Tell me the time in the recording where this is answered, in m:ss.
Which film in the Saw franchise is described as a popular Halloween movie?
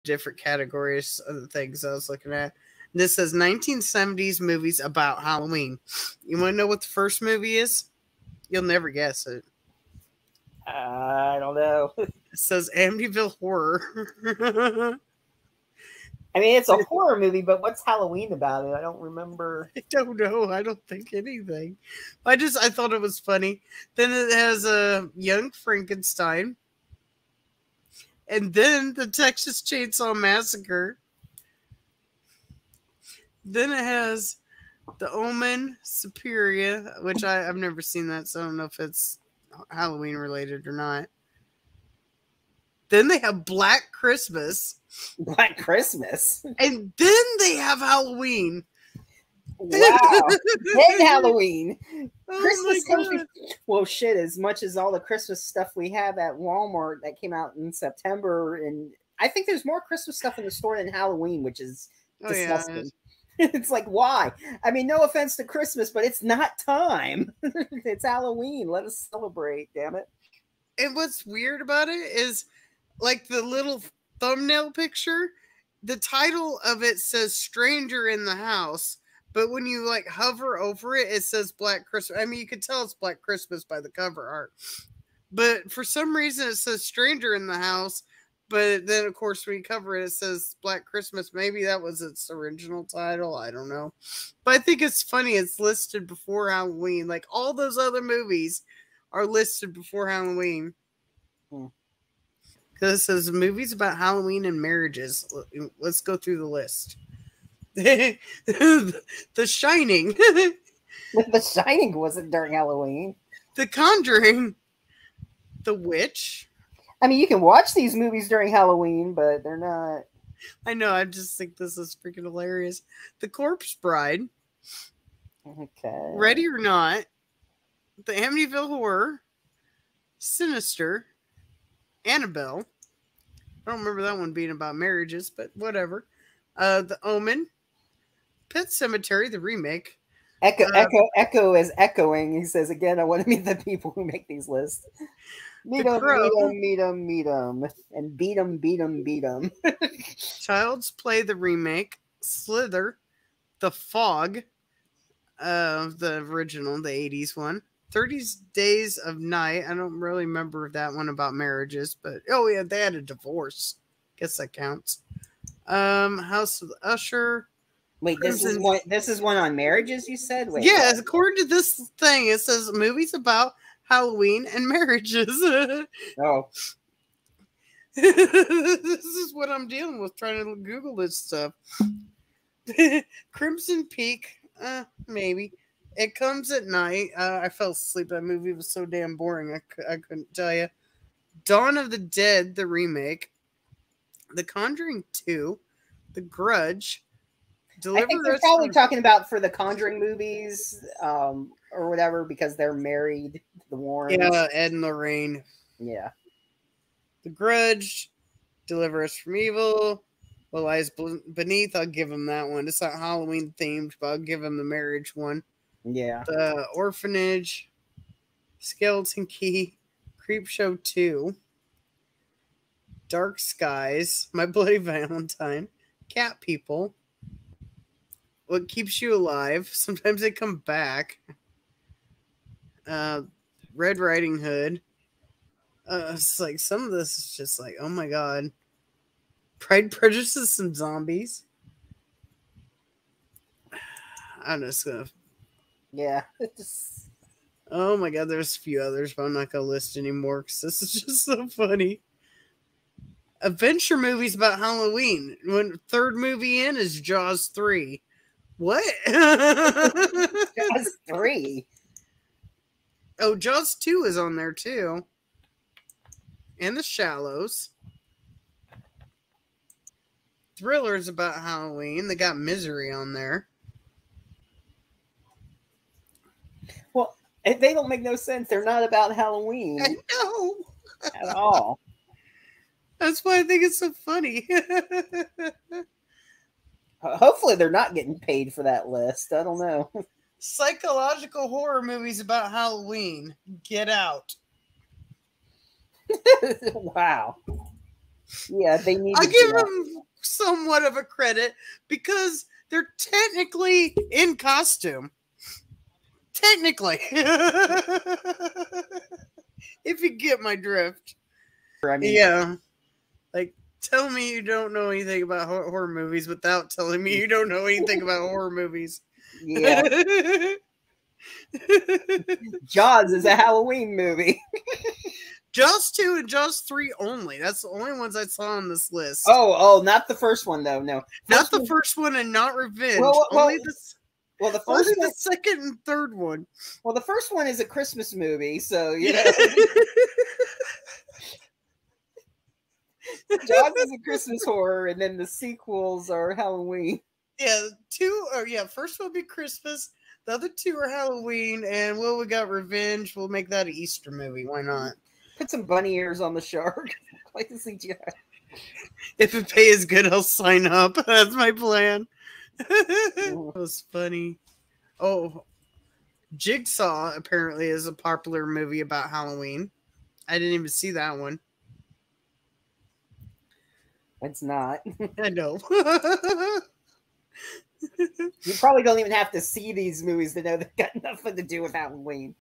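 6:06.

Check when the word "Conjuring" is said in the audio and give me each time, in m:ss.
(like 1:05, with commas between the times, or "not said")
1:53, 3:14, 3:19.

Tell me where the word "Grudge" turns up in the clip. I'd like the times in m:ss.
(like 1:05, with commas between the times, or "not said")
3:16, 3:27.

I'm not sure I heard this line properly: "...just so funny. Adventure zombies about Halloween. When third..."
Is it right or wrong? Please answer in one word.
wrong.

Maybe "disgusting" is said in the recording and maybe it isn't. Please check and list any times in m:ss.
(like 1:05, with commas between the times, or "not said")
1:02.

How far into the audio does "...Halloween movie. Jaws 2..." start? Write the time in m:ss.
5:23.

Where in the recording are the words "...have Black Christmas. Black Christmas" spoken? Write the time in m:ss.
0:43.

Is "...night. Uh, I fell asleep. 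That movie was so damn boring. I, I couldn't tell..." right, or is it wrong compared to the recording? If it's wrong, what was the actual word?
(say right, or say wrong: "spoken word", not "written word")
right.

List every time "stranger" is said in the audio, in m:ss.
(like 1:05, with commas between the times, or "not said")
1:17, 1:26.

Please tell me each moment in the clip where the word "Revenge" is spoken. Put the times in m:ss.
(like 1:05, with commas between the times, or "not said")
5:32, 5:52.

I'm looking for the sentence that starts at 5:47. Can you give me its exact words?
Yeah, two or yeah, first will be Christmas.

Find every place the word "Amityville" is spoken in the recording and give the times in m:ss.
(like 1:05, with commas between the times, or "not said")
0:12, 2:08.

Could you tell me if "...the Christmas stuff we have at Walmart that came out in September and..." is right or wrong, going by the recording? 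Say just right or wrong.
right.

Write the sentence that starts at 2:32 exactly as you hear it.
Slither, The Fog, of uh, the original, the '80s one.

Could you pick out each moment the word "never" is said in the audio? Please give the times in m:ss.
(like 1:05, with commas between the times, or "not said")
0:08, 0:37.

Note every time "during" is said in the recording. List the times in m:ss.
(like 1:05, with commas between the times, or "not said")
1:52, 1:58.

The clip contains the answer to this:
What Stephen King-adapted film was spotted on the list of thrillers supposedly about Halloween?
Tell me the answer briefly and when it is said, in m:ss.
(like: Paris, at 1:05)
Misery, at 4:32.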